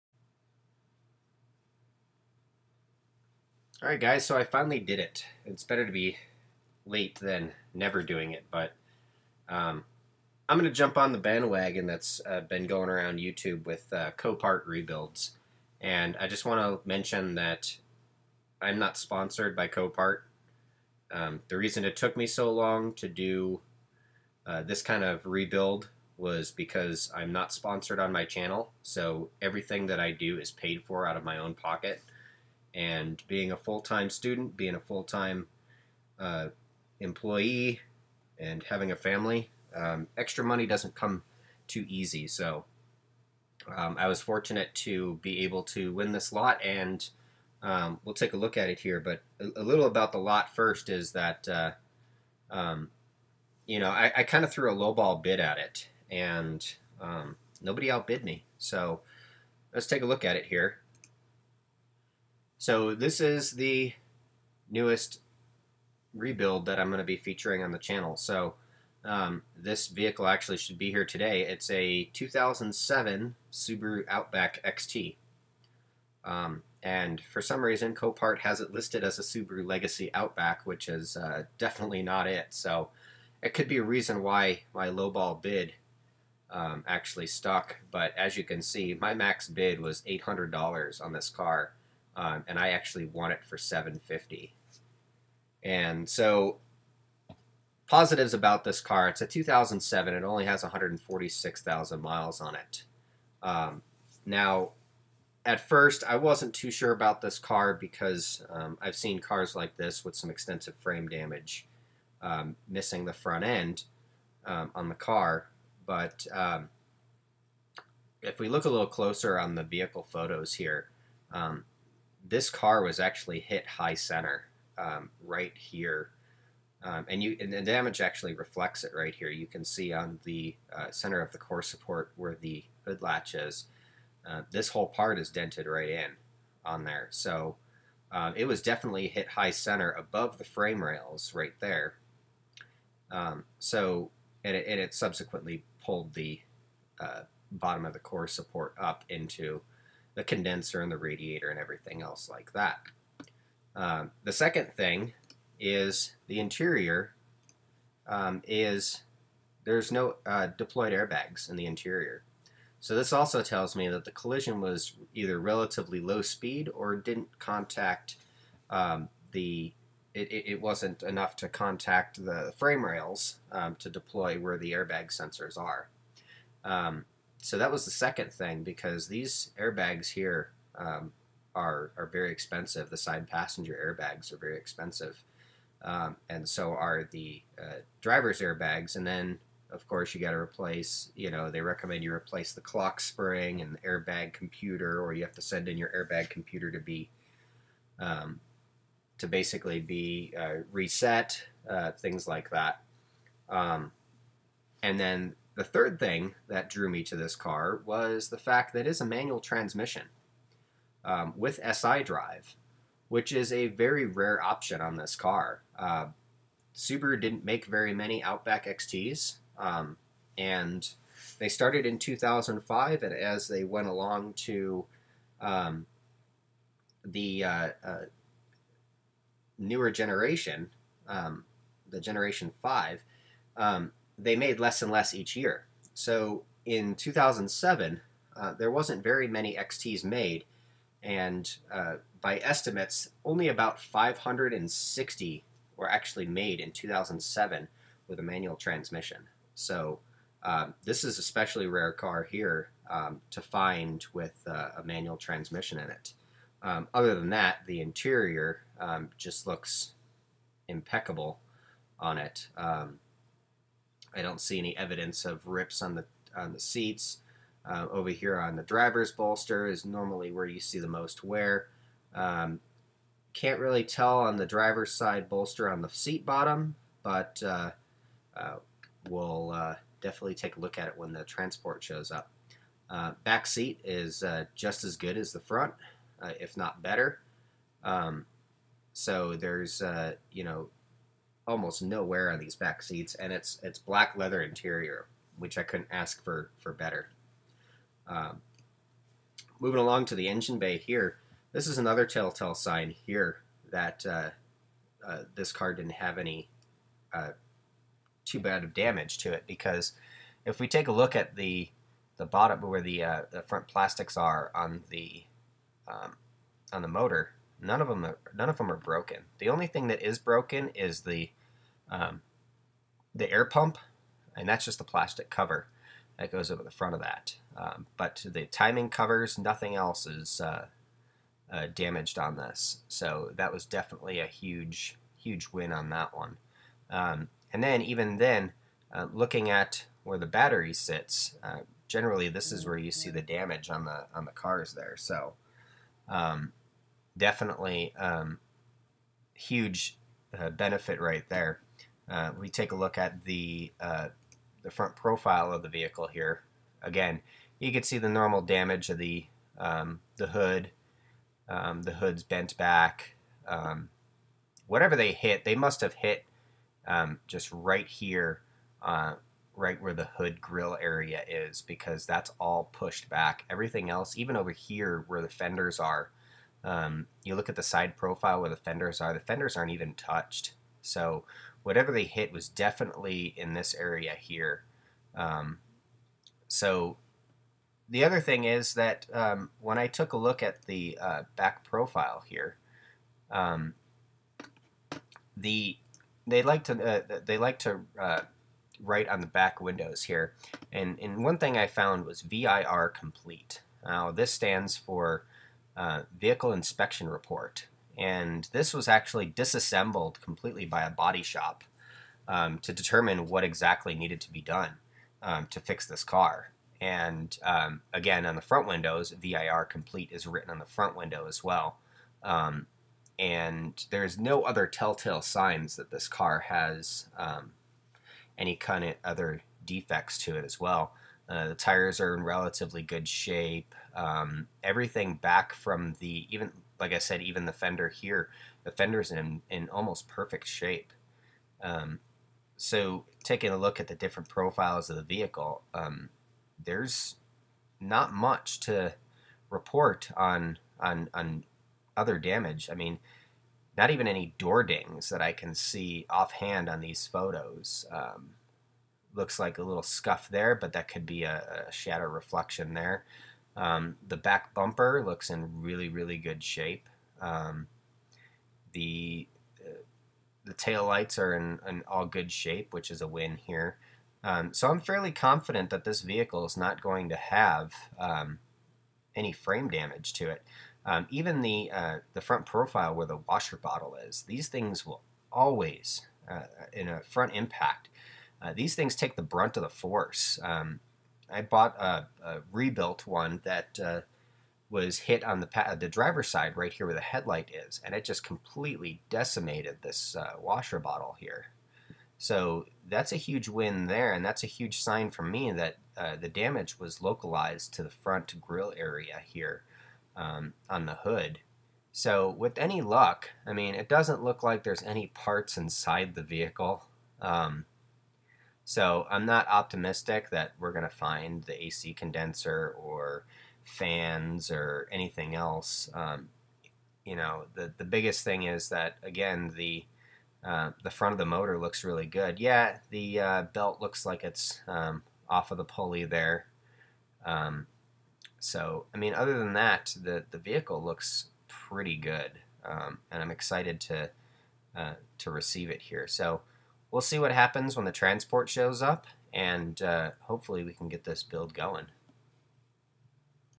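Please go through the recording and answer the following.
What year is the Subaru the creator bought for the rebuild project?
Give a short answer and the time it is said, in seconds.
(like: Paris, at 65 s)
2007, at 72 s.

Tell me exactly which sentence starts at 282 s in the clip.
Uh, back seat is uh, just as good as the front, if not better.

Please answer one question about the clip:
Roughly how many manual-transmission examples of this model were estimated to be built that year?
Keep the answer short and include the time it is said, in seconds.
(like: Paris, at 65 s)
560, at 243 s.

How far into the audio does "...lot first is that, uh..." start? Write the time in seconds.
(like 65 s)
50 s.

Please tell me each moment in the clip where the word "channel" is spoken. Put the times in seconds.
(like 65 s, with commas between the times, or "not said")
28 s, 67 s.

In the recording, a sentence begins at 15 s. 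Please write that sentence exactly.
And I just want to mention that I'm not sponsored by Copart.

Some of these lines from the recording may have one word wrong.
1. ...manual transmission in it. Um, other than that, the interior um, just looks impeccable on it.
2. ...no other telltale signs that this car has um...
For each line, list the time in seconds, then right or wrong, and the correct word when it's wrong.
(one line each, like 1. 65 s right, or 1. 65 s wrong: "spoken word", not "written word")
1. 254 s right
2. 424 s right.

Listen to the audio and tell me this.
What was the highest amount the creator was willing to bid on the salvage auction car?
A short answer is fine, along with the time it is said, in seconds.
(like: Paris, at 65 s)
$800, at 90 s.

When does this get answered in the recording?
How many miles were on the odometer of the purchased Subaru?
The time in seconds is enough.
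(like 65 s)
100 s.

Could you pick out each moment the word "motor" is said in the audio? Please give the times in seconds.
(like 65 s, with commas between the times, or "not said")
316 s, 531 s.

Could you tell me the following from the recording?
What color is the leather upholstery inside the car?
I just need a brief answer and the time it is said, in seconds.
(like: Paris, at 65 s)
Black, at 293 s.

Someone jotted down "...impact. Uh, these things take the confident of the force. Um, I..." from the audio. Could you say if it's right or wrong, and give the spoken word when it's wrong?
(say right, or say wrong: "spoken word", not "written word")
wrong: "brunt", not "confident".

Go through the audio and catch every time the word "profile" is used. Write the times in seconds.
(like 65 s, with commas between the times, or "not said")
354 s, 377 s, 391 s, 444 s, 482 s.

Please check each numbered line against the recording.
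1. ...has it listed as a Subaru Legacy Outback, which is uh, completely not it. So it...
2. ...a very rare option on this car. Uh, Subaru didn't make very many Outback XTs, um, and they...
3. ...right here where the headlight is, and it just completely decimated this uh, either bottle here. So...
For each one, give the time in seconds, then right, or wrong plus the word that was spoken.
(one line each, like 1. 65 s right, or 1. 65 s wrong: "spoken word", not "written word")
1. 78 s wrong: "definitely", not "completely"
2. 213 s right
3. 496 s wrong: "washer", not "either".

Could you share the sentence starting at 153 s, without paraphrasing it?
Um, the second thing is the interior um, is there's no uh, deployed airbags in the interior.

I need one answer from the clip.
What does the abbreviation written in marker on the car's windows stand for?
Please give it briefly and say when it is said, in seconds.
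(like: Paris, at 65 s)
Vehicle Inspection Report, at 406 s.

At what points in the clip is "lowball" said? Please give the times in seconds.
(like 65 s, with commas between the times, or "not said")
54 s, 84 s.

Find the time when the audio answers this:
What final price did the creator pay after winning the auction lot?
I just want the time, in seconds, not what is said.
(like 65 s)
93 s.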